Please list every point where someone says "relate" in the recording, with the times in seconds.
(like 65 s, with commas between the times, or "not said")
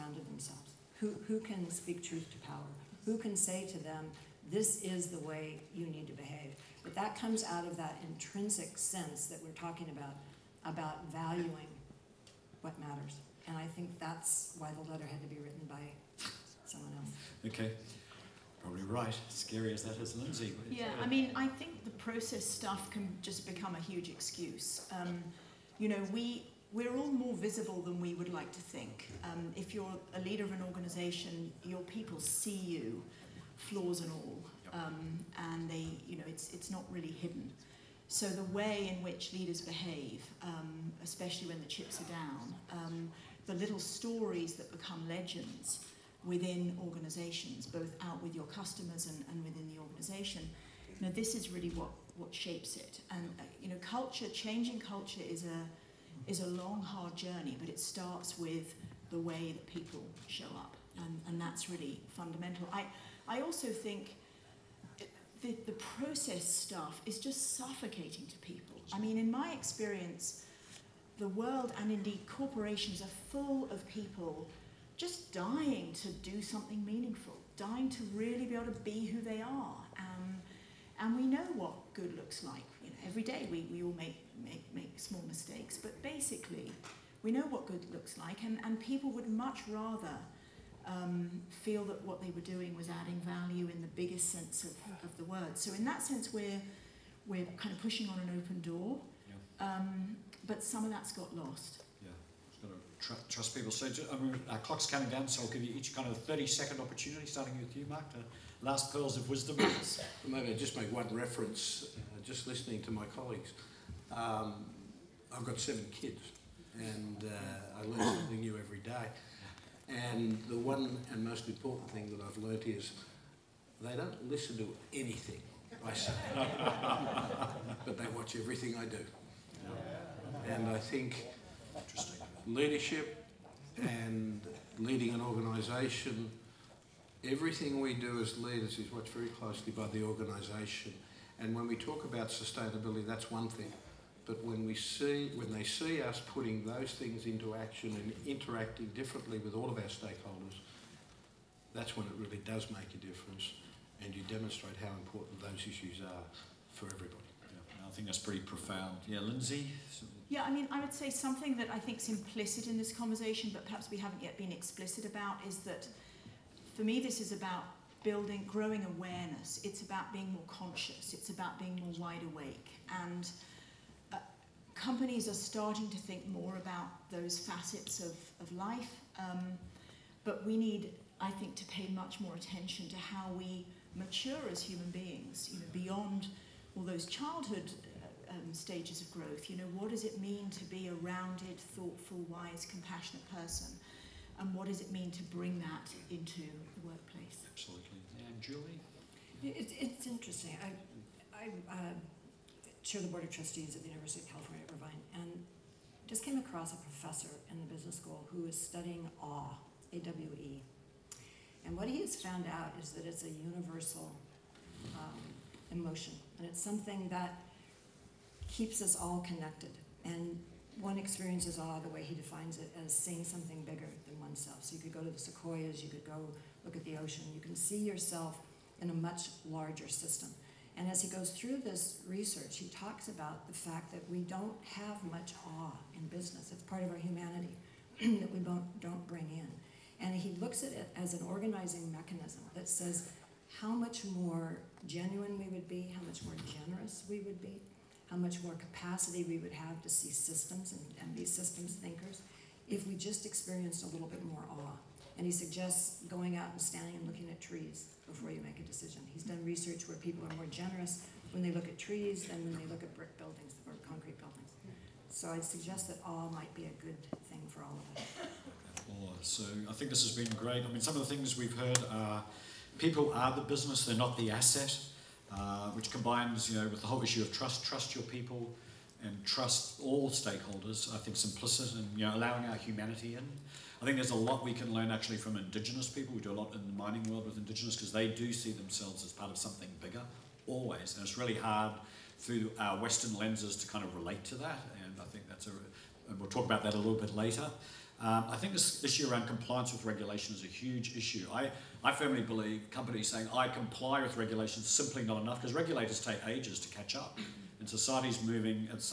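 293 s.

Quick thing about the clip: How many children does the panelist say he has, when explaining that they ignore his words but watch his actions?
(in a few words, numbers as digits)
7.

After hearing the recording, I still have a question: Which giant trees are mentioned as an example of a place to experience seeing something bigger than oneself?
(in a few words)
Sequoias.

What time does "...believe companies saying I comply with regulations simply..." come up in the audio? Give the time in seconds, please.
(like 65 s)
302 s.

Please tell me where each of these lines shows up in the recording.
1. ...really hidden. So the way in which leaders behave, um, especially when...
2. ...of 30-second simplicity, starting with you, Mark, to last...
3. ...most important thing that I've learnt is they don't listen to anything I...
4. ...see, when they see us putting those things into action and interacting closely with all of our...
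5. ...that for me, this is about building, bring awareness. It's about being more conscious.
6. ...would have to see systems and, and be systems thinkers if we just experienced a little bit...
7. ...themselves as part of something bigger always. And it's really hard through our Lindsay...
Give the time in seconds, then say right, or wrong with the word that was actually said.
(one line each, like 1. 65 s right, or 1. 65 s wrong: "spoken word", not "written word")
1. 36 s right
2. 106 s wrong: "opportunity", not "simplicity"
3. 121 s right
4. 144 s wrong: "differently", not "closely"
5. 165 s wrong: "growing", not "bring"
6. 249 s right
7. 288 s wrong: "Western", not "Lindsay".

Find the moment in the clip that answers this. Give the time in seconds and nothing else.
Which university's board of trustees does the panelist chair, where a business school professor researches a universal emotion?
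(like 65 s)
203 s.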